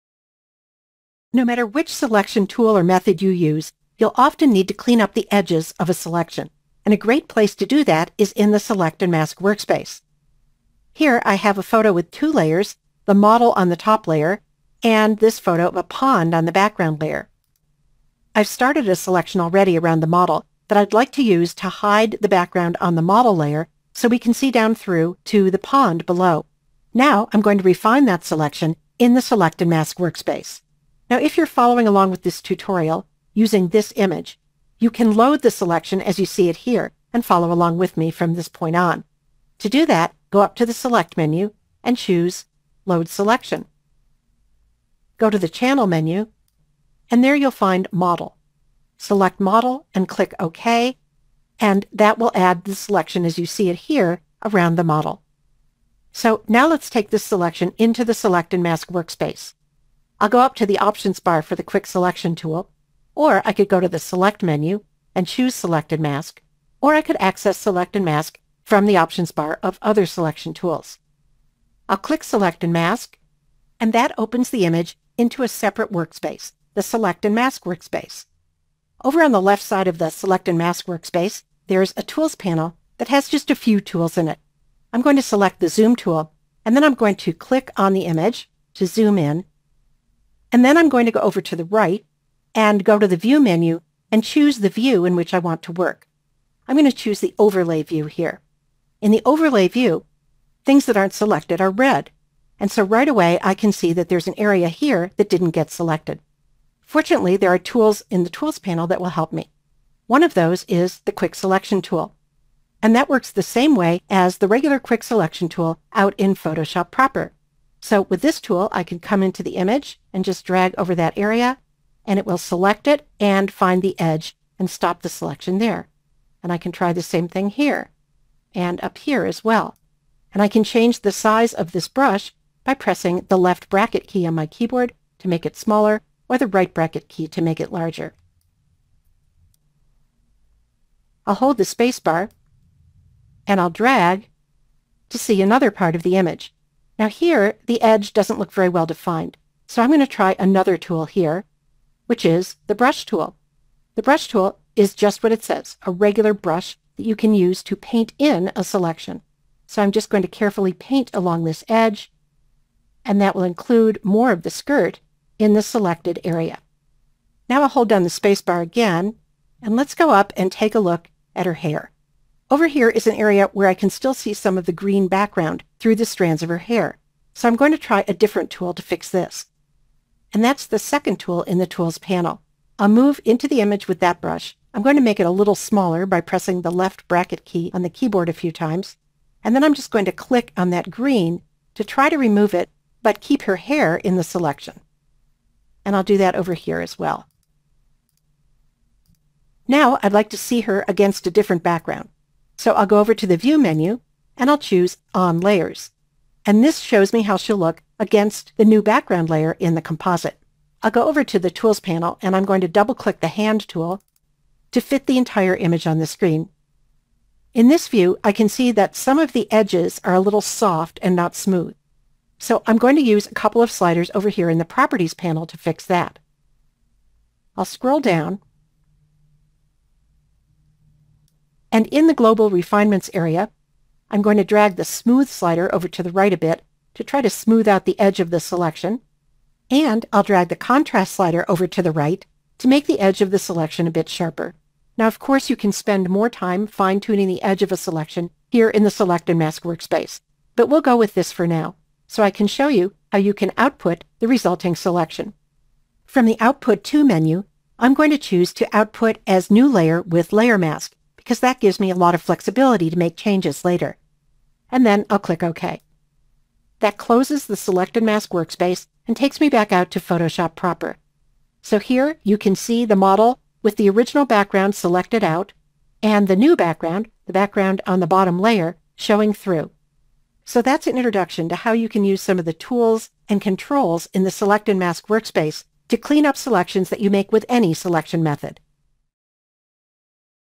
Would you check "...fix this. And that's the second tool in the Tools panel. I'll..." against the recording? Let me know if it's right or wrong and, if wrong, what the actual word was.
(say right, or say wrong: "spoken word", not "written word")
right.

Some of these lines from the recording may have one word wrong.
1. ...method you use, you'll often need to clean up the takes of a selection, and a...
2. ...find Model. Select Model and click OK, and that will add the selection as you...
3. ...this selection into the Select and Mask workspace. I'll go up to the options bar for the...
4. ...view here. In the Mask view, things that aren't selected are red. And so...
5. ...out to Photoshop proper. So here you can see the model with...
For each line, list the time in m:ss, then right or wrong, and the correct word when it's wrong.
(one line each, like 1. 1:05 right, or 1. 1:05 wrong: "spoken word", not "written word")
1. 0:02 wrong: "edges", not "takes"
2. 0:47 right
3. 0:57 right
4. 1:37 wrong: "Overlay", not "Mask"
5. 4:29 right.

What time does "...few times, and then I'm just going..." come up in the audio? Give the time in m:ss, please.
3:08.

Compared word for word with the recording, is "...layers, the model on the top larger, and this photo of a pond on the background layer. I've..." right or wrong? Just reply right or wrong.
wrong.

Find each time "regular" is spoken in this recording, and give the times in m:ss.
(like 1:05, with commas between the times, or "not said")
1:54, 2:35.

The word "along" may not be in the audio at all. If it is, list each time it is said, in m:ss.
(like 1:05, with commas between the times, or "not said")
0:31, 0:37, 2:41.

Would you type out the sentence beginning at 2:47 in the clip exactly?
Now I'll hold down the spacebar again, and let's go up and take a look at her hair.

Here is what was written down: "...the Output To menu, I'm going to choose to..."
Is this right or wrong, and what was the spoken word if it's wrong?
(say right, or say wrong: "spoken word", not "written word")
right.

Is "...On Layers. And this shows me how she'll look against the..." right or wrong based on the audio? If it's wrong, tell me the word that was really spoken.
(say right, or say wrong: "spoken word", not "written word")
right.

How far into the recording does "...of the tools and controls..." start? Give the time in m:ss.
4:42.